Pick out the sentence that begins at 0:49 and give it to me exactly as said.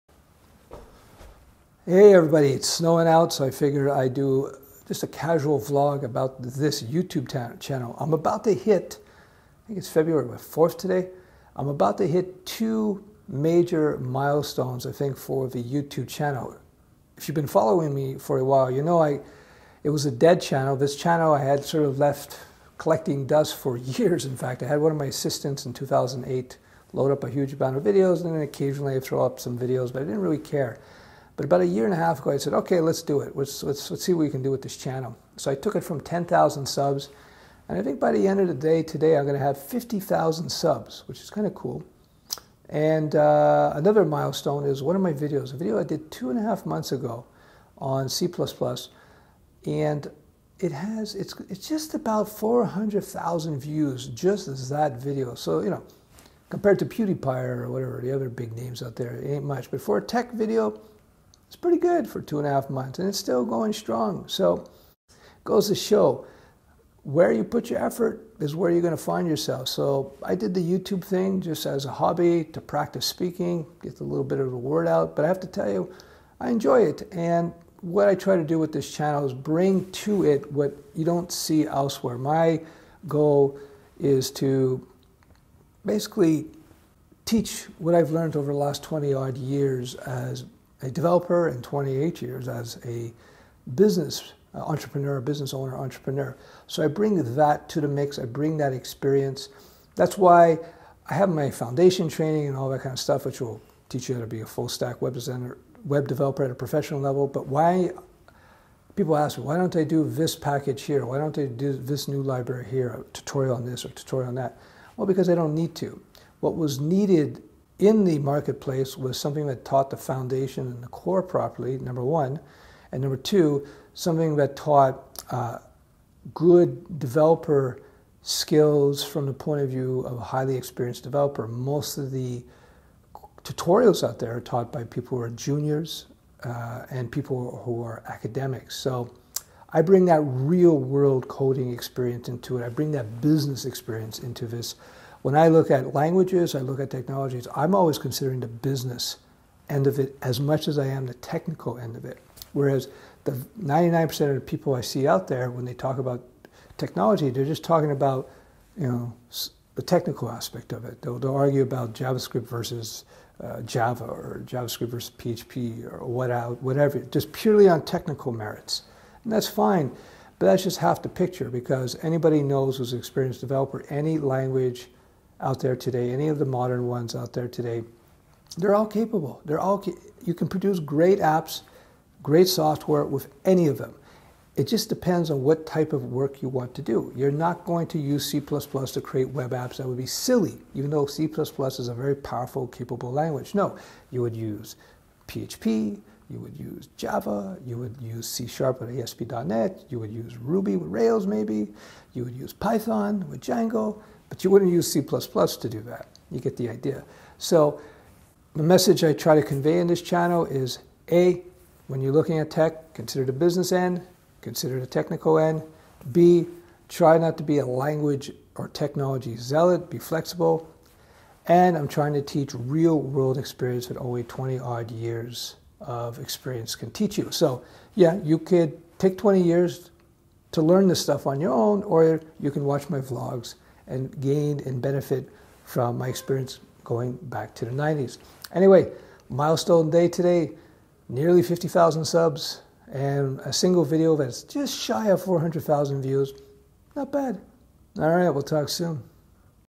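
And it has, it's, it's just about 400,000 views, just as that video.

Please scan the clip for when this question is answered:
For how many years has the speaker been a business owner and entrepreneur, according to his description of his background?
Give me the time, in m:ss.
1:31.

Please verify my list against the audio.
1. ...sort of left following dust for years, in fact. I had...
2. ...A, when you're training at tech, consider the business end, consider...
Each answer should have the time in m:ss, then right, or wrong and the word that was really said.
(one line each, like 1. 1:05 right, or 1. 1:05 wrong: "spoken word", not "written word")
1. 0:21 wrong: "collecting", not "following"
2. 3:31 wrong: "looking", not "training".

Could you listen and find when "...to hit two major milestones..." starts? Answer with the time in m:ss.
0:11.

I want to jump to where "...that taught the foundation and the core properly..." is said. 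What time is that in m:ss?
1:59.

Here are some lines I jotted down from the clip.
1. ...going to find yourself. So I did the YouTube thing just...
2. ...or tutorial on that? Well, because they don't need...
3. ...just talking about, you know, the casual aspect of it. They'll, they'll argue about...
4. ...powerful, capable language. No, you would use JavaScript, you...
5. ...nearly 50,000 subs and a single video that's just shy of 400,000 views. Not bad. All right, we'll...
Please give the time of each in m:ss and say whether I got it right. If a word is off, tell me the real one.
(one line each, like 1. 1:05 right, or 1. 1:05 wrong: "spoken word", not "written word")
1. 1:08 right
2. 1:53 right
3. 2:37 wrong: "technical", not "casual"
4. 3:12 wrong: "PHP", not "JavaScript"
5. 4:01 right.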